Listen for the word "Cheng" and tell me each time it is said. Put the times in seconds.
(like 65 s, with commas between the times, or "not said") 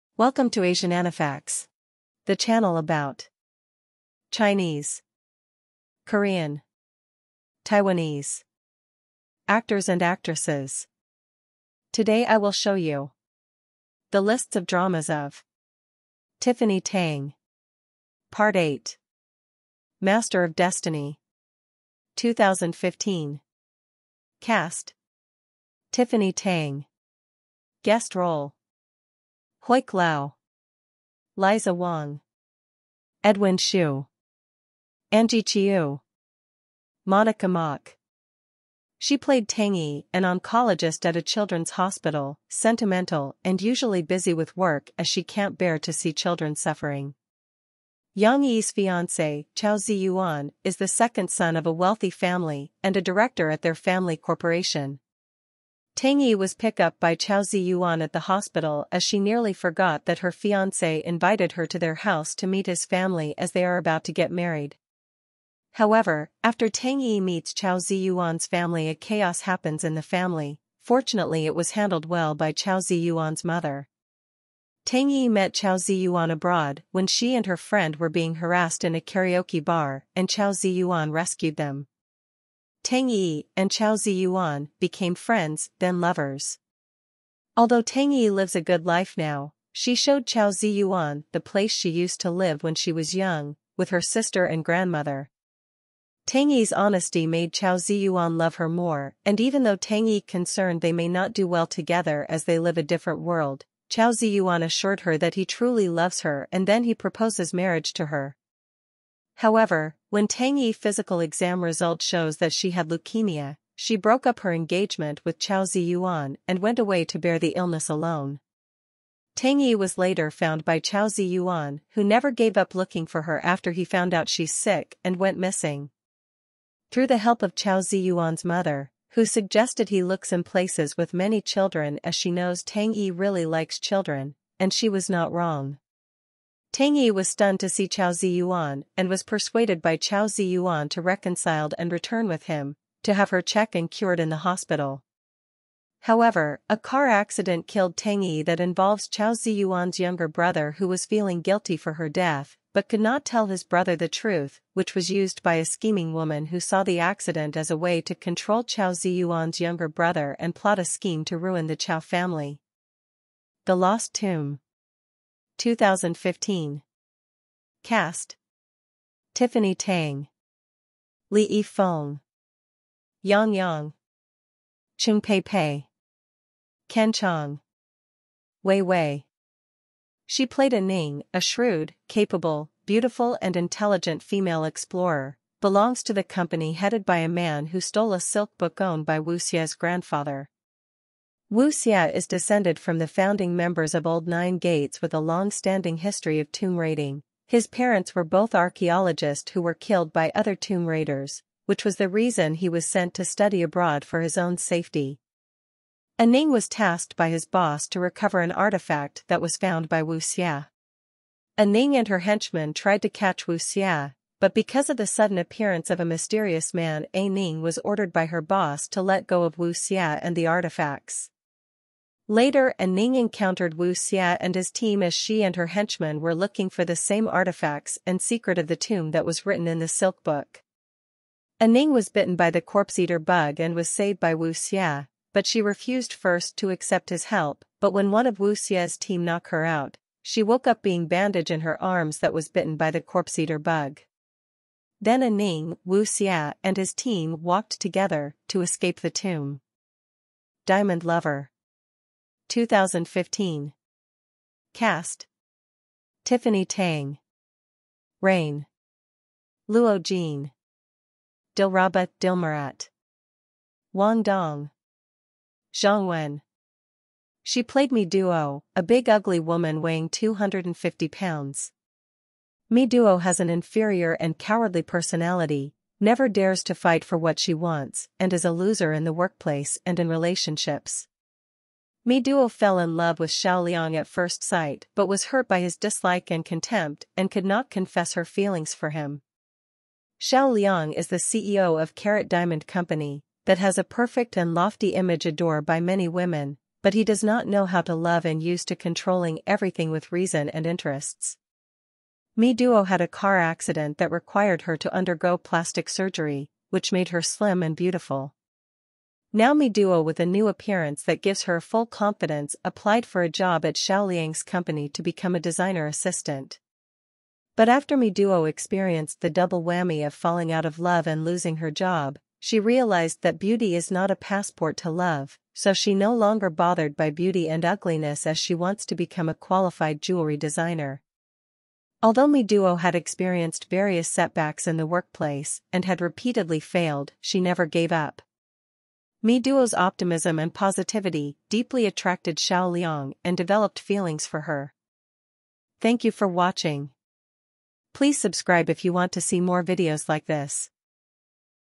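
174 s.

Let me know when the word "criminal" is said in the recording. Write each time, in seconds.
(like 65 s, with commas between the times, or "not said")
not said.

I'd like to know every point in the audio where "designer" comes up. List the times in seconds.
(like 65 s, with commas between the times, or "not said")
315 s, 330 s.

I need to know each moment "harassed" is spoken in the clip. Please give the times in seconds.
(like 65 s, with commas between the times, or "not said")
78 s.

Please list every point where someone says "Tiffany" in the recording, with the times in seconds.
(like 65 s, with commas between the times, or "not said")
16 s, 25 s, 169 s, 256 s.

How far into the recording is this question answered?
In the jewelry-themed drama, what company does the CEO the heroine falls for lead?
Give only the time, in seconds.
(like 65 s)
291 s.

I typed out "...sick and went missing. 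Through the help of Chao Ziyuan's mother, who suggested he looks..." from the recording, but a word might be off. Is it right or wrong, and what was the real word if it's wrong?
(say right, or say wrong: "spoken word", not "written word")
right.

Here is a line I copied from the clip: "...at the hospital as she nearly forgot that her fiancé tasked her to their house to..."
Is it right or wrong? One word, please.
wrong.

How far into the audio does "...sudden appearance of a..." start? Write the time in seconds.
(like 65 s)
215 s.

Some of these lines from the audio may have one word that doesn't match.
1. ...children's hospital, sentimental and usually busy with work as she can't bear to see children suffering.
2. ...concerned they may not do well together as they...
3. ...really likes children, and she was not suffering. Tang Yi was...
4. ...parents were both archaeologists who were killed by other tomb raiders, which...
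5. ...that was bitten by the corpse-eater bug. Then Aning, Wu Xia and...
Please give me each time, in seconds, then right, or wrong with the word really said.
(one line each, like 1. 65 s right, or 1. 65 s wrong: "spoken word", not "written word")
1. 41 s right
2. 100 s right
3. 133 s wrong: "wrong", not "suffering"
4. 197 s right
5. 242 s right.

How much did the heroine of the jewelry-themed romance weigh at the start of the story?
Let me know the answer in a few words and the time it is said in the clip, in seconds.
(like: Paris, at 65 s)
250 pounds, at 270 s.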